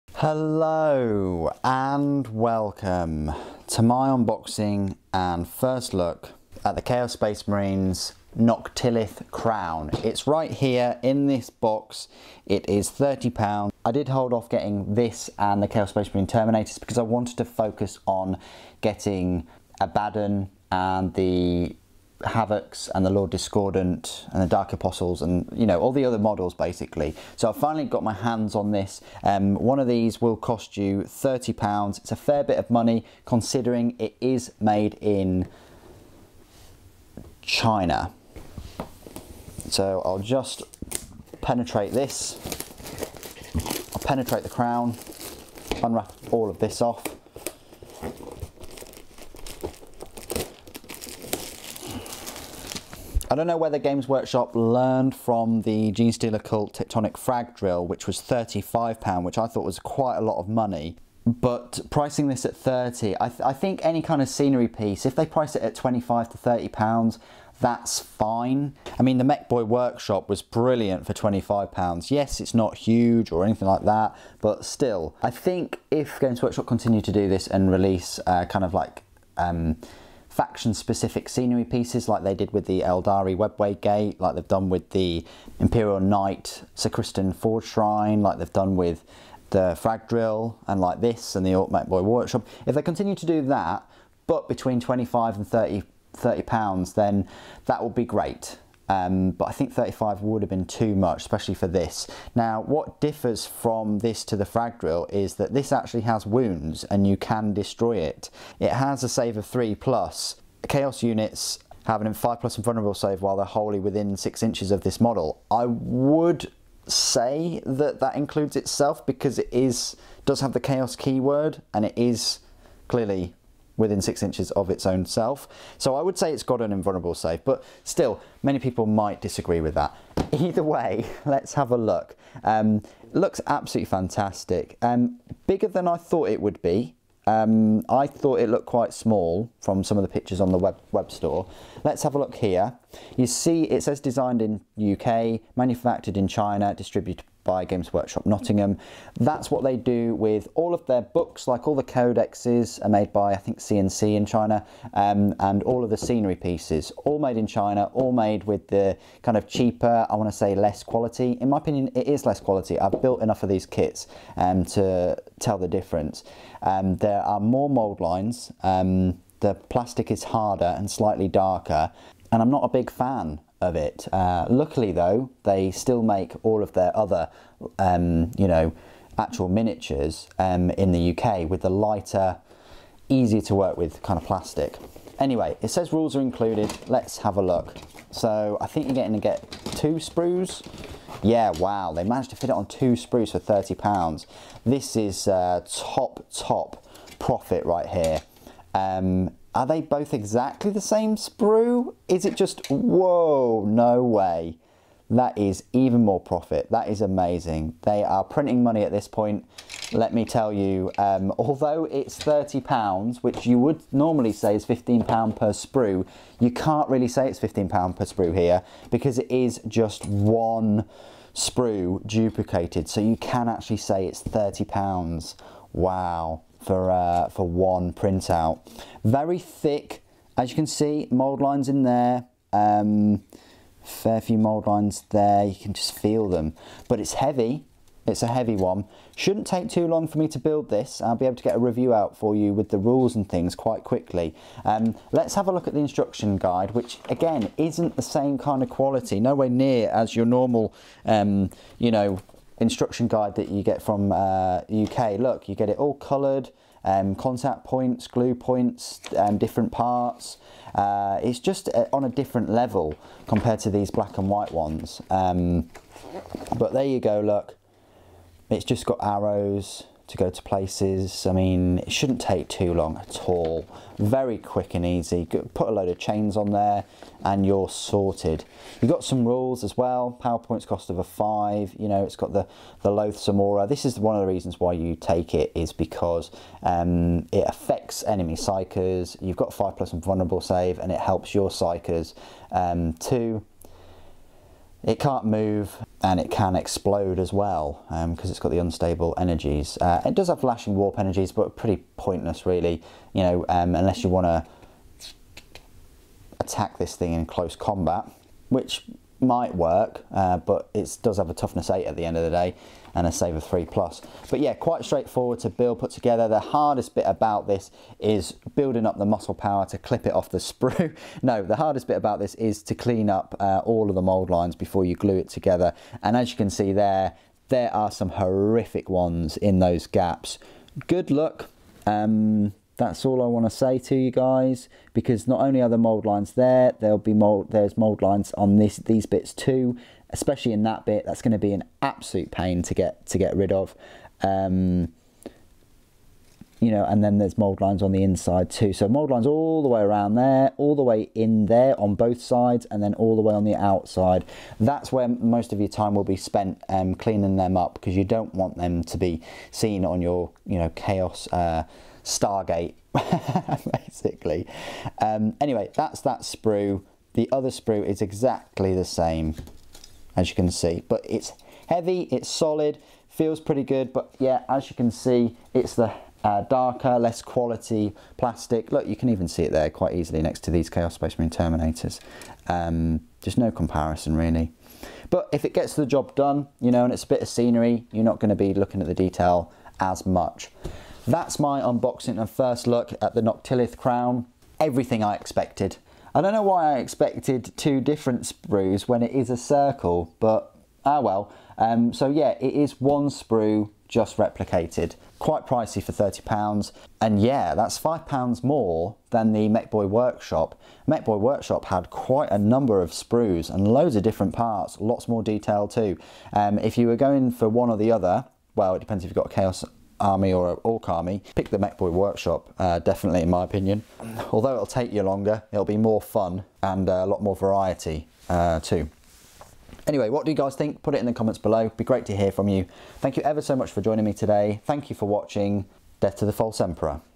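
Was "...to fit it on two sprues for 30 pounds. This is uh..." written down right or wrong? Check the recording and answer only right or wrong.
right.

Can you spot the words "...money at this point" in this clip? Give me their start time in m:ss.
3:28.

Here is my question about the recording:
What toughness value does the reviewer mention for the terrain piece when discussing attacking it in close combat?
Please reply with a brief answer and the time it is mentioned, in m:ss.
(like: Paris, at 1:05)
8, at 5:11.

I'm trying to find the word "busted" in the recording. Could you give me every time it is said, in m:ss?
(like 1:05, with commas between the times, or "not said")
not said.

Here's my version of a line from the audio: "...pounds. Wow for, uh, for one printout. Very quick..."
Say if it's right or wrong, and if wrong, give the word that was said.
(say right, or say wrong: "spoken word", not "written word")
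wrong: "thick", not "quick".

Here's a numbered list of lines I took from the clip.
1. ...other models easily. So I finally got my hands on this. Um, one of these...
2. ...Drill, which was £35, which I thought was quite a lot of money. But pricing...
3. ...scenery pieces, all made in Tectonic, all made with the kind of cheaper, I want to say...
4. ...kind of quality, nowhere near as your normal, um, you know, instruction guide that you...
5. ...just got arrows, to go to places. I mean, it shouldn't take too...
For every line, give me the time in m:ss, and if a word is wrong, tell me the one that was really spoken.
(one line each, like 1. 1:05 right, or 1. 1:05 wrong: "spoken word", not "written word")
1. 0:26 wrong: "basically", not "easily"
2. 0:57 right
3. 2:35 wrong: "China", not "Tectonic"
4. 4:08 right
5. 4:28 right.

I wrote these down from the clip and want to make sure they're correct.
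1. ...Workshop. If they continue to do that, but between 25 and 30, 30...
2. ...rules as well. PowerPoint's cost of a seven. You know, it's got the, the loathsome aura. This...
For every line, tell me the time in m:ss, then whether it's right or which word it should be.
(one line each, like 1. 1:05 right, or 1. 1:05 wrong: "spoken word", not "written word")
1. 1:32 right
2. 4:39 wrong: "five", not "seven".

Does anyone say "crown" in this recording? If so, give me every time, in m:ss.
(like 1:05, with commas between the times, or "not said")
0:09, 0:44, 6:33.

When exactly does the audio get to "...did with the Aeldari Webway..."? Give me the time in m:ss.
1:22.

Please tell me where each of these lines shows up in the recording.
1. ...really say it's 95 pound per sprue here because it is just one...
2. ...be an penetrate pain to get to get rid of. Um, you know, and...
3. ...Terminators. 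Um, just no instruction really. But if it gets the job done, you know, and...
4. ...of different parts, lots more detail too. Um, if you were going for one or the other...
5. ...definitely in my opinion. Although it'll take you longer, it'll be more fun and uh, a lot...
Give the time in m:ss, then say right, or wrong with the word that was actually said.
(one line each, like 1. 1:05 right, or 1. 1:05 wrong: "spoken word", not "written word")
1. 3:36 wrong: "15", not "95"
2. 5:41 wrong: "absolute", not "penetrate"
3. 6:21 wrong: "comparison", not "instruction"
4. 6:53 right
5. 7:02 right.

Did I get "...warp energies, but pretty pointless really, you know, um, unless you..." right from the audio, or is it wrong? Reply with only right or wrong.
right.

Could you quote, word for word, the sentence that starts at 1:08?
I mean, the Mekboy Workshop was brilliant for £25.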